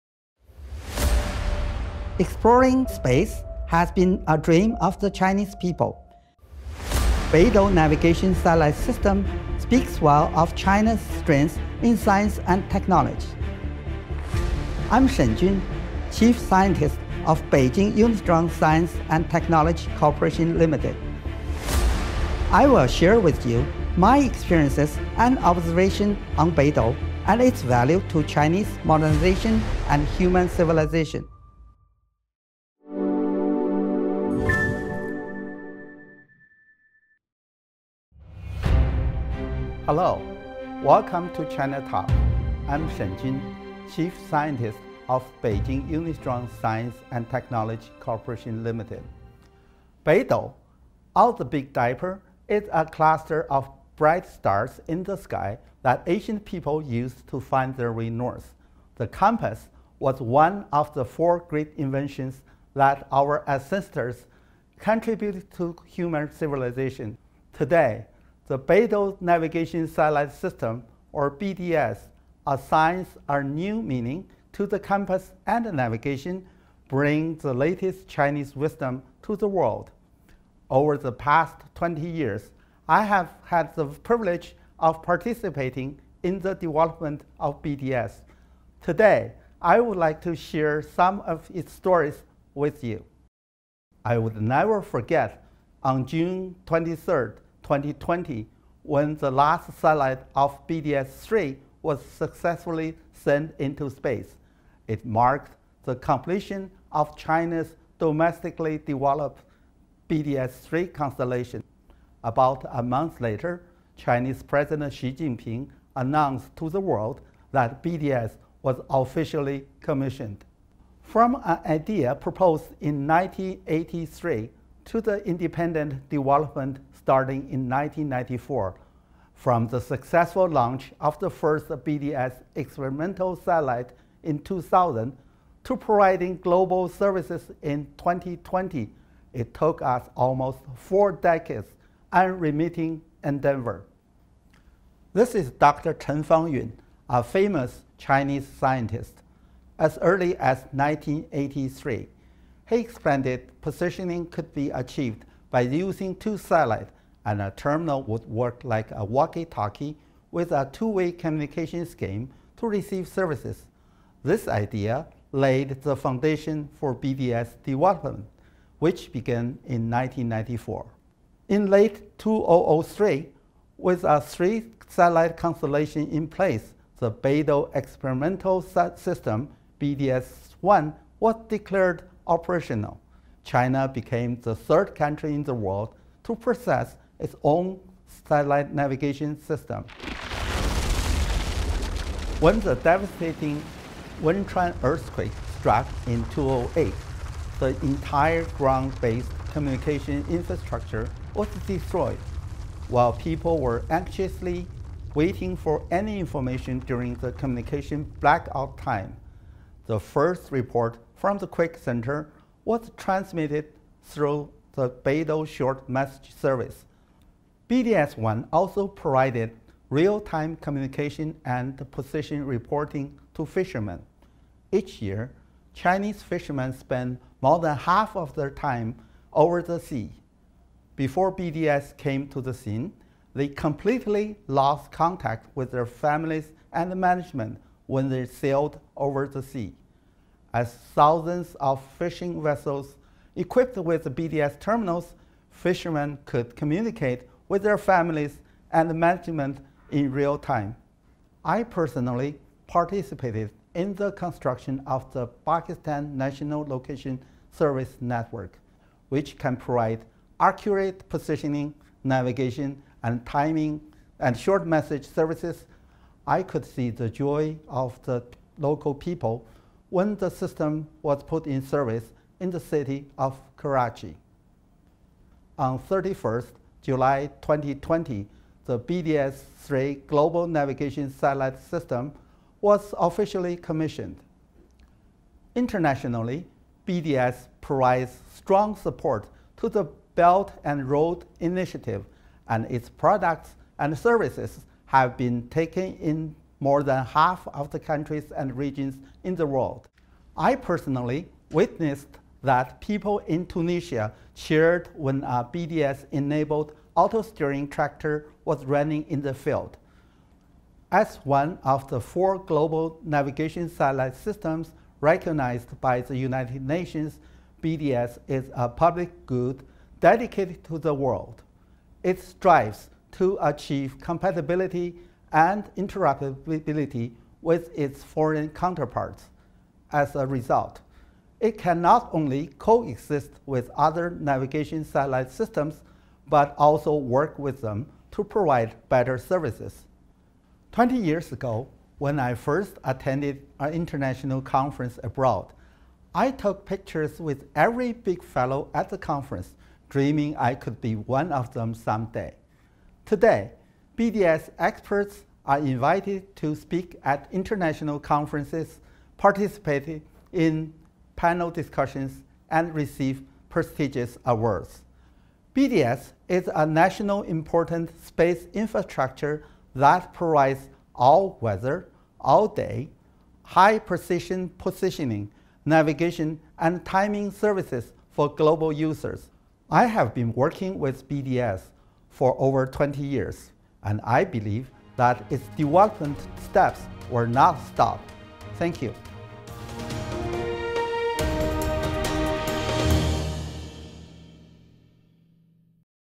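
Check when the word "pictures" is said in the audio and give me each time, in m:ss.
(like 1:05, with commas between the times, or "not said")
5:46.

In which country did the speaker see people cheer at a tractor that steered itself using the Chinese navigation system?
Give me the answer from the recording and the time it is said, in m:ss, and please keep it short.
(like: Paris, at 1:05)
Tunisia, at 5:03.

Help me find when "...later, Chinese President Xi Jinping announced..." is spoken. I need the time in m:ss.
1:53.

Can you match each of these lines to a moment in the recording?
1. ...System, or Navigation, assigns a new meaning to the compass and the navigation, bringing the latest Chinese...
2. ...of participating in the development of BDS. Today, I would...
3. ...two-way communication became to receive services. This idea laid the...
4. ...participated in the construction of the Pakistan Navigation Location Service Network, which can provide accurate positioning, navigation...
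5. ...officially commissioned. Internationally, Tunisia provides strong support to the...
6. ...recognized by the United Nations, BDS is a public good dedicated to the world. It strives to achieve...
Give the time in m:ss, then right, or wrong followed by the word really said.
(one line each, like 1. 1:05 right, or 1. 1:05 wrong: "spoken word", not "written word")
1. 1:10 wrong: "BDS", not "Navigation"
2. 1:24 right
3. 2:40 wrong: "scheme", not "became"
4. 4:12 wrong: "National", not "Navigation"
5. 4:42 wrong: "BDS", not "Tunisia"
6. 5:15 right.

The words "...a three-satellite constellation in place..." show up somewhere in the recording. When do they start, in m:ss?
2:54.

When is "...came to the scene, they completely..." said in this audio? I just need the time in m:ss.
3:51.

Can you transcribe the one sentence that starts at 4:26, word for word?
I could see the joy of the local people when the system was put in service in the city of Karachi.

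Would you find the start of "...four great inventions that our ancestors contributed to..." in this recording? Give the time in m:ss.
1:01.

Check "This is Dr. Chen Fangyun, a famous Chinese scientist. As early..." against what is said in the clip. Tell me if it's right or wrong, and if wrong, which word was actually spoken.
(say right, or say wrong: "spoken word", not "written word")
right.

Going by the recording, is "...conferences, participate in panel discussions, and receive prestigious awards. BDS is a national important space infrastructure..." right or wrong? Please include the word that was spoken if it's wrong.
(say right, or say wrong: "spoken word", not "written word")
right.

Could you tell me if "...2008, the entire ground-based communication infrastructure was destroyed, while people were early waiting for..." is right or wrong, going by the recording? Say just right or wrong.
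wrong.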